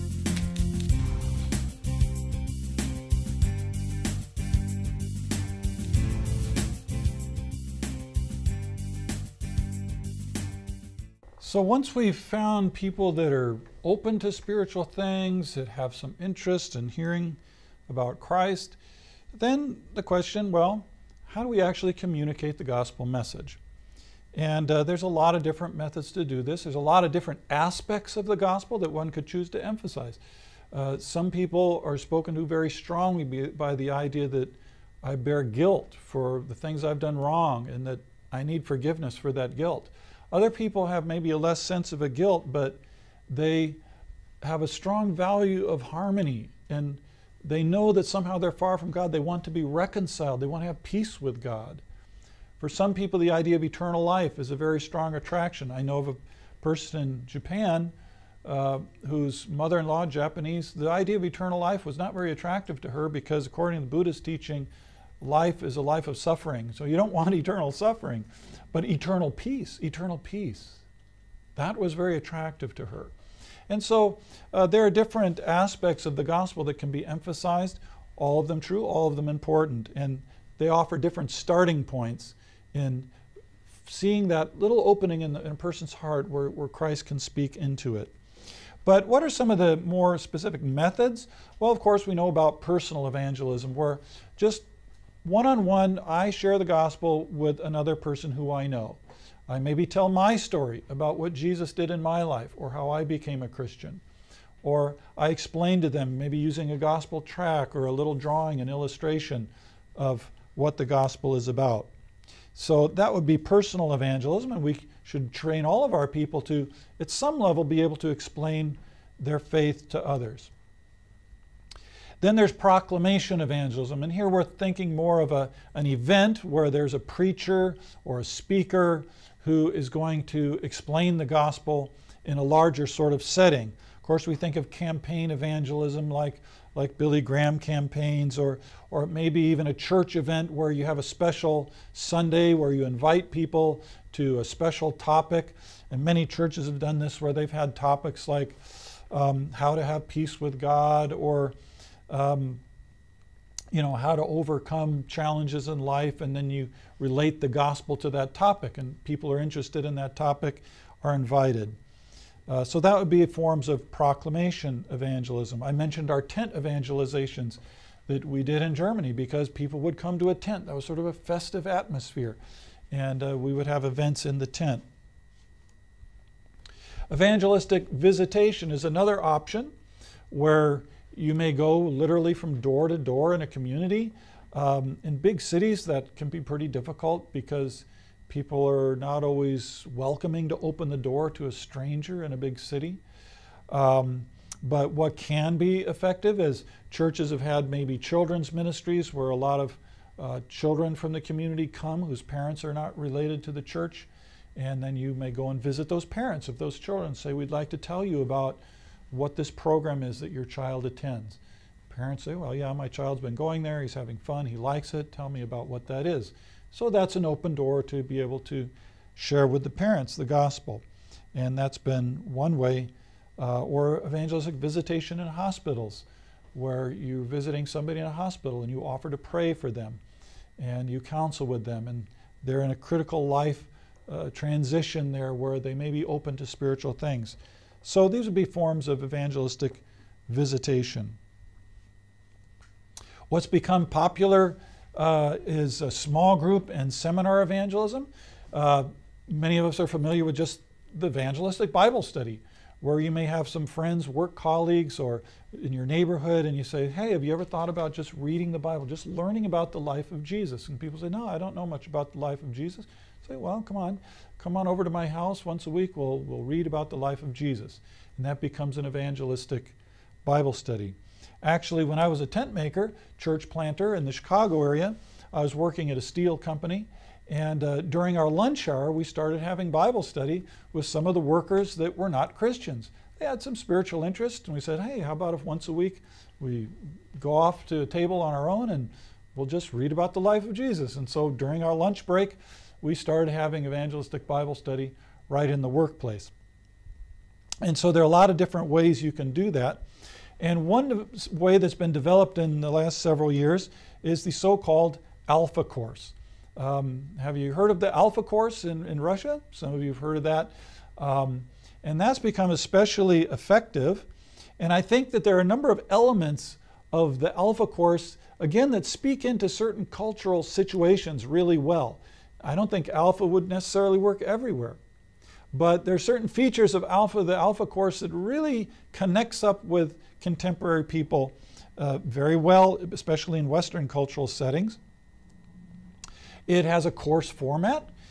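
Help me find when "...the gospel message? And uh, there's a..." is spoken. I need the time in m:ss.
0:22.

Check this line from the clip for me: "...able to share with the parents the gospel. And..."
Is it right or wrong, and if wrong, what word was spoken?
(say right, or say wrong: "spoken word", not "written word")
right.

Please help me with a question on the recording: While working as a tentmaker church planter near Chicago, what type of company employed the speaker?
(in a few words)
A steel company.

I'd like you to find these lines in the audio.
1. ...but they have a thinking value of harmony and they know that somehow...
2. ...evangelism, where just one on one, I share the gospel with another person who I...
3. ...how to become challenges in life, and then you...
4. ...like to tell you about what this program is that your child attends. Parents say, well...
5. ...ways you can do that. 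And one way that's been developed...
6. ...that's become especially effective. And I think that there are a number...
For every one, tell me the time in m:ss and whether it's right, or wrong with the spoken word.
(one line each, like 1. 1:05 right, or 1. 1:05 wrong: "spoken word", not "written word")
1. 0:42 wrong: "strong", not "thinking"
2. 1:33 right
3. 2:33 wrong: "overcome", not "become"
4. 3:27 right
5. 4:58 right
6. 5:12 right.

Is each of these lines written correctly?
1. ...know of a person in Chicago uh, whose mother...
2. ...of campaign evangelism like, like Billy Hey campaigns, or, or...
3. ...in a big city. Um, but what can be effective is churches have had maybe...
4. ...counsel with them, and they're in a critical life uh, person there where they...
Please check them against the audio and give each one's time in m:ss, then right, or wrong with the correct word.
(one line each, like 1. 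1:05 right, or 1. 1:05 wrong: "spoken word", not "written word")
1. 0:55 wrong: "Japan", not "Chicago"
2. 2:14 wrong: "Graham", not "Hey"
3. 3:12 right
4. 3:51 wrong: "transition", not "person".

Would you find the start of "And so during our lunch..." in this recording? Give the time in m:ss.
4:50.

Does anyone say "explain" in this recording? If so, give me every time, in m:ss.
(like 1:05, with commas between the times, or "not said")
1:45, 1:58, 2:10.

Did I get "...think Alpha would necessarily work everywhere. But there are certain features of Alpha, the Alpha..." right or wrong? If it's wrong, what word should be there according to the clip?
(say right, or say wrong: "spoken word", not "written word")
right.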